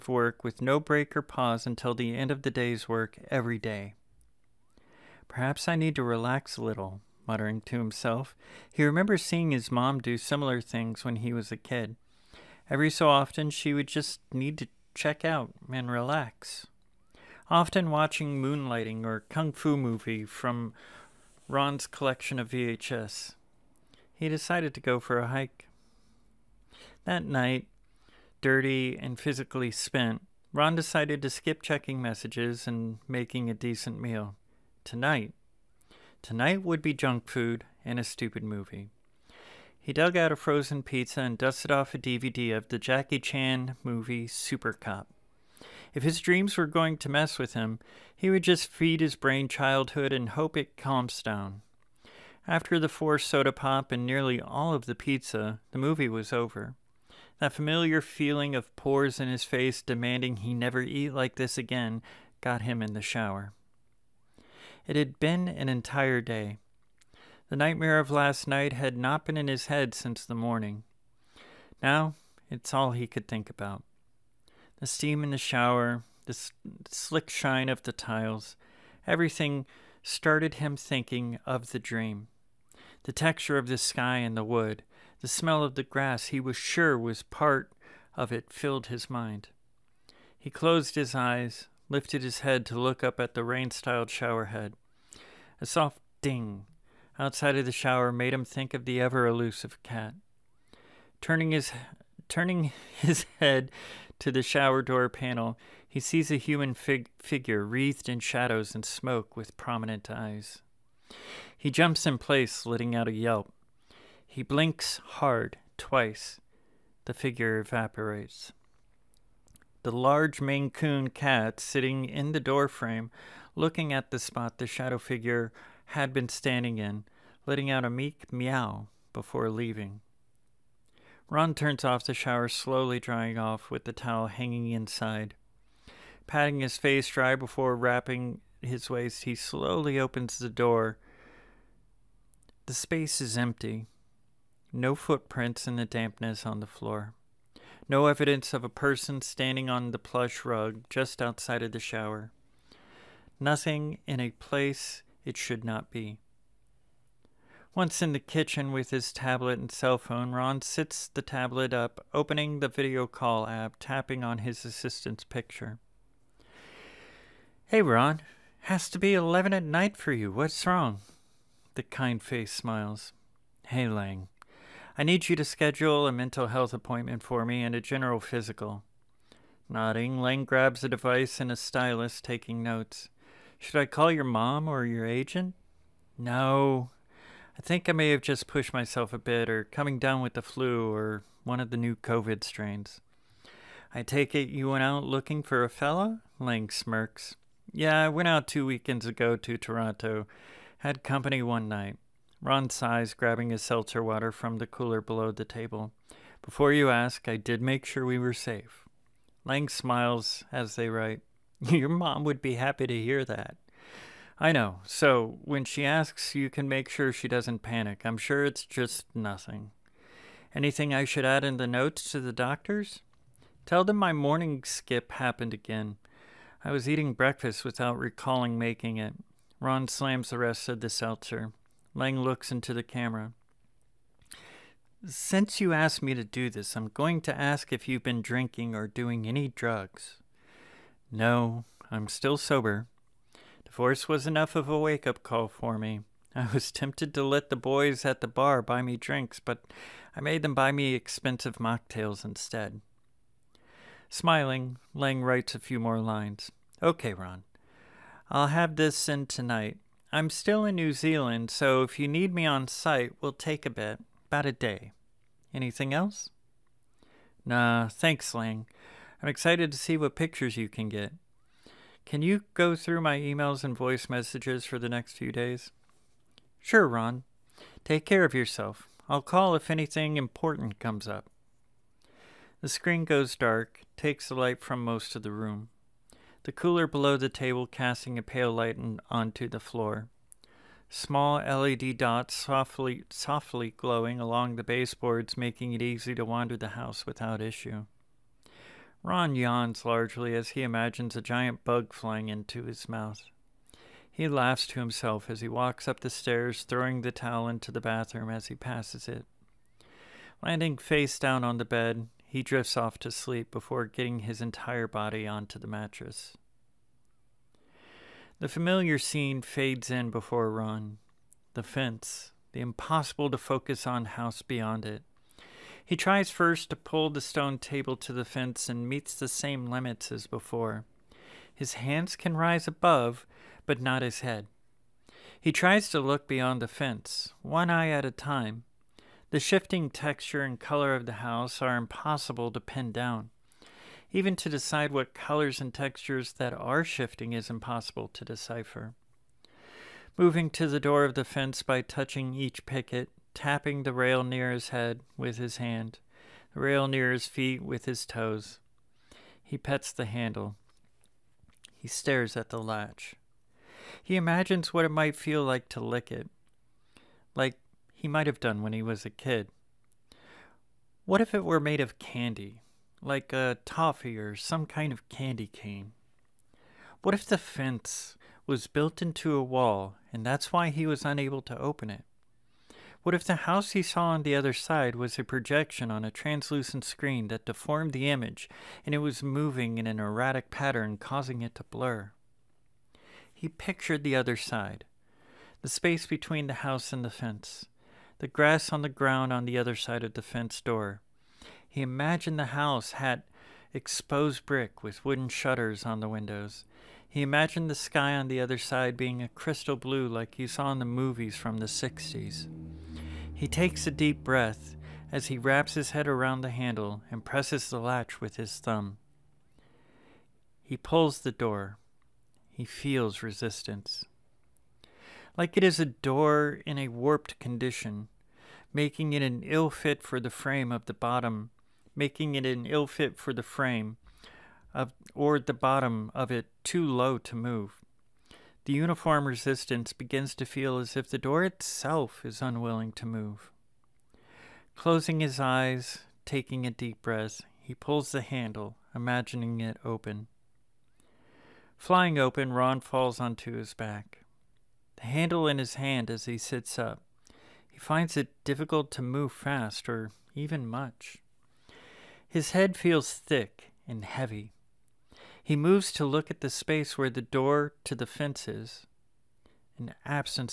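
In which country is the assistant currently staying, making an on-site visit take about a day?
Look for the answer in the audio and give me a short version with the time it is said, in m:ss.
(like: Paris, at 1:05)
New Zealand, at 4:20.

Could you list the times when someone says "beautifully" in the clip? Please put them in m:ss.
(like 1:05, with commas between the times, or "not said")
not said.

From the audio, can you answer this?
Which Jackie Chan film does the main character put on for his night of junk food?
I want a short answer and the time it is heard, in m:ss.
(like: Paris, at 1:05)
Super Cop, at 0:44.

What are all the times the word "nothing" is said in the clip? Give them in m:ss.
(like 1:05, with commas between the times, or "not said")
2:33, 3:39.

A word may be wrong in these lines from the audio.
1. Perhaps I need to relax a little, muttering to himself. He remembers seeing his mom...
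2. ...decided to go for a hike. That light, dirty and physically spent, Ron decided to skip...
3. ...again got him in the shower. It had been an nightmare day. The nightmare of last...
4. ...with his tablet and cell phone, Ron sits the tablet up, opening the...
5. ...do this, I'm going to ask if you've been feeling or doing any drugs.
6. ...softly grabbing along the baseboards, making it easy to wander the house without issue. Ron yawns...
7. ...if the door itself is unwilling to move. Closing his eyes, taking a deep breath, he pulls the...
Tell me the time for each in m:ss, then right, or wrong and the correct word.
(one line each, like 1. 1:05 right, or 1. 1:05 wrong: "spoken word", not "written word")
1. 0:05 right
2. 0:24 wrong: "night", not "light"
3. 1:01 wrong: "entire", not "nightmare"
4. 2:38 right
5. 3:56 wrong: "drinking", not "feeling"
6. 4:53 wrong: "glowing", not "grabbing"
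7. 7:20 right.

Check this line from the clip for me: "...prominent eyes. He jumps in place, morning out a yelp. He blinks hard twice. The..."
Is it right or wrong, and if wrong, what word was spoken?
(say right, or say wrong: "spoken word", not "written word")
wrong: "letting", not "morning".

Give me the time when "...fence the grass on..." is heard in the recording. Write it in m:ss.
6:37.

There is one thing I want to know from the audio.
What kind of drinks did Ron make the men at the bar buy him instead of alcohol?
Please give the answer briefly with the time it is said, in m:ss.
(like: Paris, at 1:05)
expensive mocktails, at 4:10.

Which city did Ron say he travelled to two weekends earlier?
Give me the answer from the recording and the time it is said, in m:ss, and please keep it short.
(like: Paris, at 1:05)
Toronto, at 3:19.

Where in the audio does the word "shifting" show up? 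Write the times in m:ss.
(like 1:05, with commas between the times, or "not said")
5:39, 5:46.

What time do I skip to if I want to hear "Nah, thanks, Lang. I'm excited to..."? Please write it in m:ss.
4:27.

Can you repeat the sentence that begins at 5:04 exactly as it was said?
He laughs to himself as he walks up the stairs, throwing the towel into the bathroom as he passes it.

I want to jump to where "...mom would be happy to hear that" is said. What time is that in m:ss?
3:31.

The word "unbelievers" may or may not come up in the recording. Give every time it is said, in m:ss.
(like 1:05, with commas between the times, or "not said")
not said.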